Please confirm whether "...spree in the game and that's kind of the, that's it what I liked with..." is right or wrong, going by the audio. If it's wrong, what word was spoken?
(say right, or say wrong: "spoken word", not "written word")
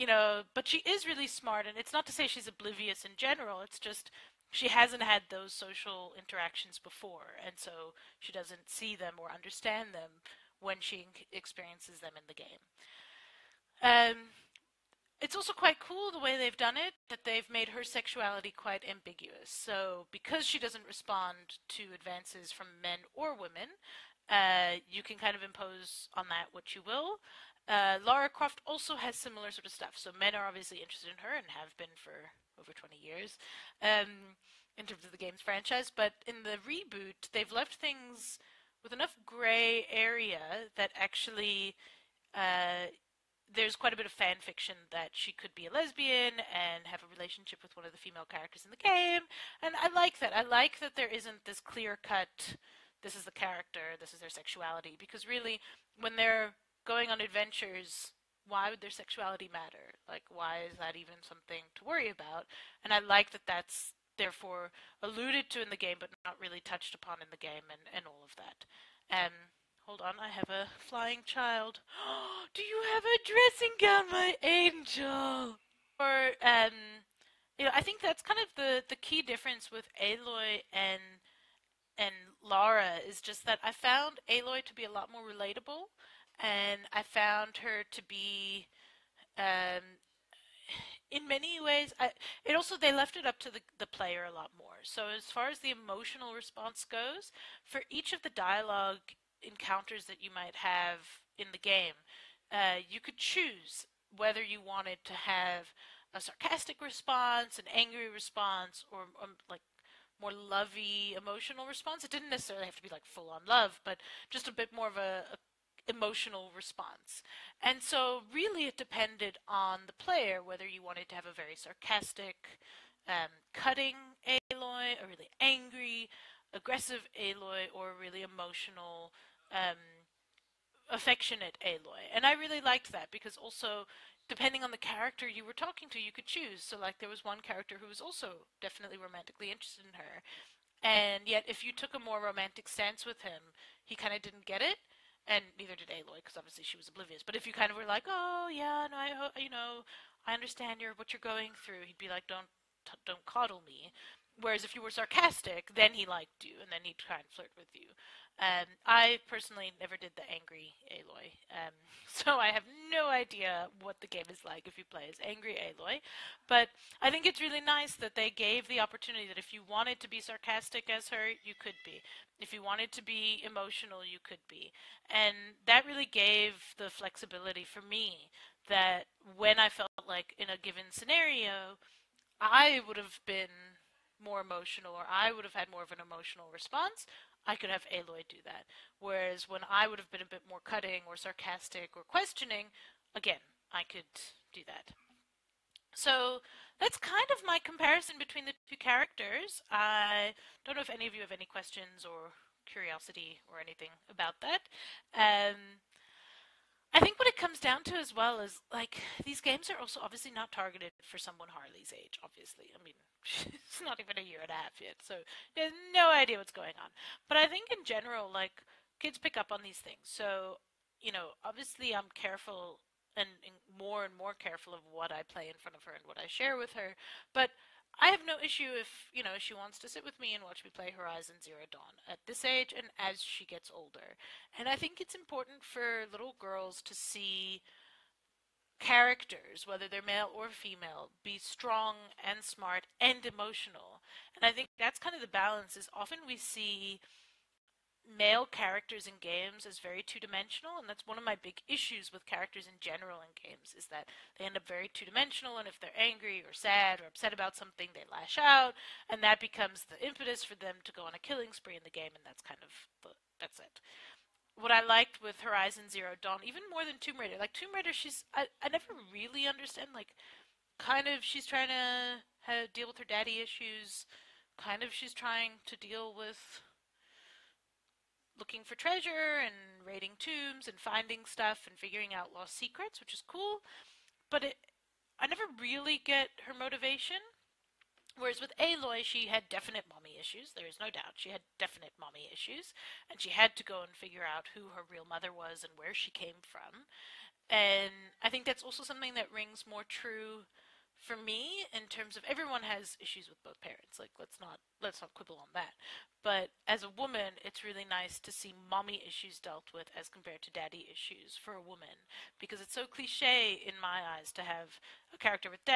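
right.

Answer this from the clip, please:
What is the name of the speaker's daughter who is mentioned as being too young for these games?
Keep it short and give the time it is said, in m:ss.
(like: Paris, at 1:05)
Harley, at 3:31.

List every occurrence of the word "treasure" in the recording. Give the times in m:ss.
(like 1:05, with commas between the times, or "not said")
4:38.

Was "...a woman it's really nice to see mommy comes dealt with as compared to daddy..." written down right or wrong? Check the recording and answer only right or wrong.
wrong.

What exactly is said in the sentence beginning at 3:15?
So that's kind of my comparison between the two characters.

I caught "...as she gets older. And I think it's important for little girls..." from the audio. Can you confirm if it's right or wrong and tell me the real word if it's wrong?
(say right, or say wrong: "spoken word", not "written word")
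right.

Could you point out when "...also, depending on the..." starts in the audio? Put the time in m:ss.
2:13.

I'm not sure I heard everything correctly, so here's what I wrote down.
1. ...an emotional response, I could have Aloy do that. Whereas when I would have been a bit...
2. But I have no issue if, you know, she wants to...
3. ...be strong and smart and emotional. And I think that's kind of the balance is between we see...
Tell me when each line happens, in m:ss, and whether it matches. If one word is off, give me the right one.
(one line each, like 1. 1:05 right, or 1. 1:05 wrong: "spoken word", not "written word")
1. 3:05 right
2. 3:47 right
3. 4:01 wrong: "often", not "between".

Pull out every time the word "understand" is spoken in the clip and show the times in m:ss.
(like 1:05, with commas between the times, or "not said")
0:09, 2:30, 4:29.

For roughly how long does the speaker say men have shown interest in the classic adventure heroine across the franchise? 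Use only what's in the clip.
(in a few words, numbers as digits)
over 20 years.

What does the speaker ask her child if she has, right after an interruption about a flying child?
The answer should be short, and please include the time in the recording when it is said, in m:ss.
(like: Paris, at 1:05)
a dressing gown, at 1:13.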